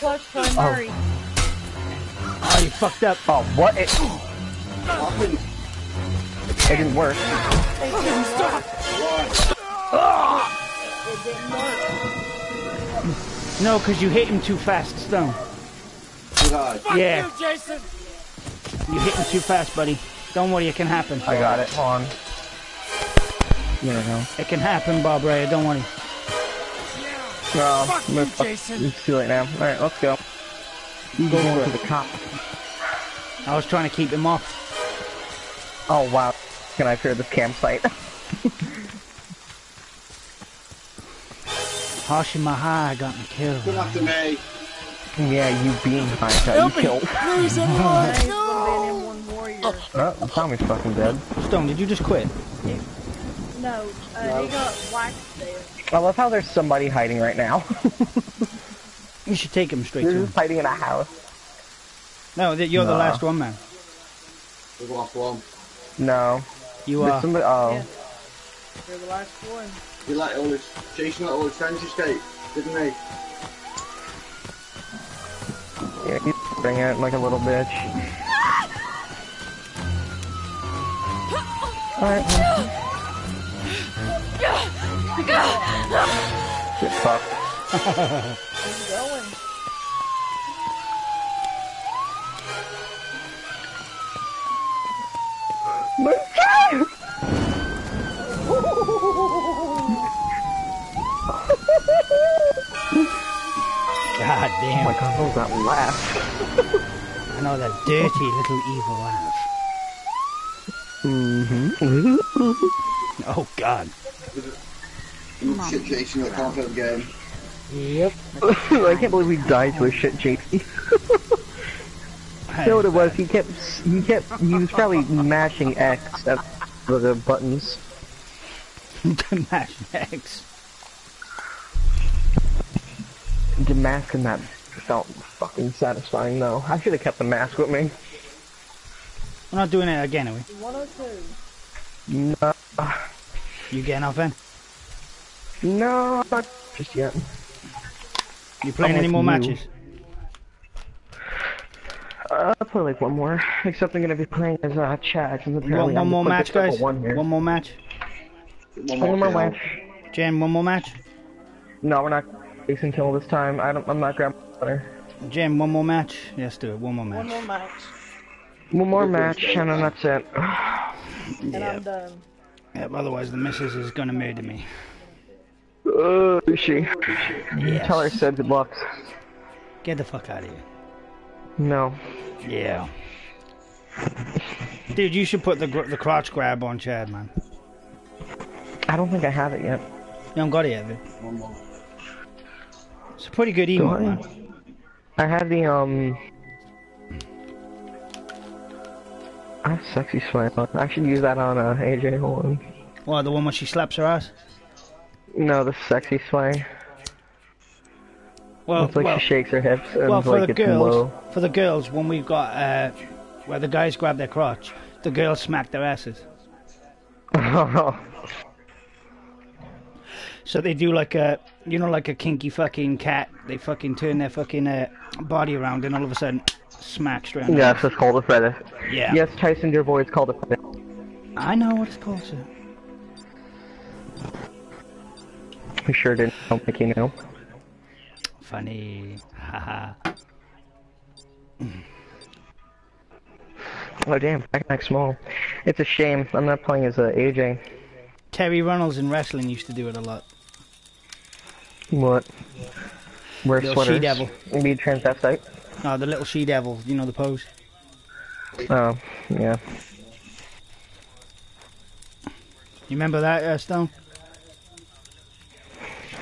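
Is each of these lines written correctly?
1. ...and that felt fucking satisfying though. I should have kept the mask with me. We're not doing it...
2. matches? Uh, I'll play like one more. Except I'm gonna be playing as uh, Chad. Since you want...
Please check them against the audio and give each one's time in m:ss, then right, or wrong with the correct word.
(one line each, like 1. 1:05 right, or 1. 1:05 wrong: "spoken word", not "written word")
1. 2:14 right
2. 2:29 right.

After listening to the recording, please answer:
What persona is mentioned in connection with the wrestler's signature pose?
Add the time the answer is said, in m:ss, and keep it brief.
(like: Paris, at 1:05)
the little she devil, at 4:15.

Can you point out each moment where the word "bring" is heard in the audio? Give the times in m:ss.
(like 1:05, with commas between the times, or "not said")
1:16.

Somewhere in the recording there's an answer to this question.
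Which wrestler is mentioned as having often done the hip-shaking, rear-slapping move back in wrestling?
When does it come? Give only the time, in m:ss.
4:08.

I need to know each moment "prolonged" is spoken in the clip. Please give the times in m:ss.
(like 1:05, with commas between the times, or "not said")
not said.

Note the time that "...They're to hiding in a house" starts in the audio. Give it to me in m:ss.
1:00.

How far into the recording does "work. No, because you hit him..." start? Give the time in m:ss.
0:13.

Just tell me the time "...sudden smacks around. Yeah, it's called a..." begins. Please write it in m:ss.
3:46.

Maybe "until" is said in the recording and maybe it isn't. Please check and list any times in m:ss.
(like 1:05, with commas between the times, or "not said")
2:42.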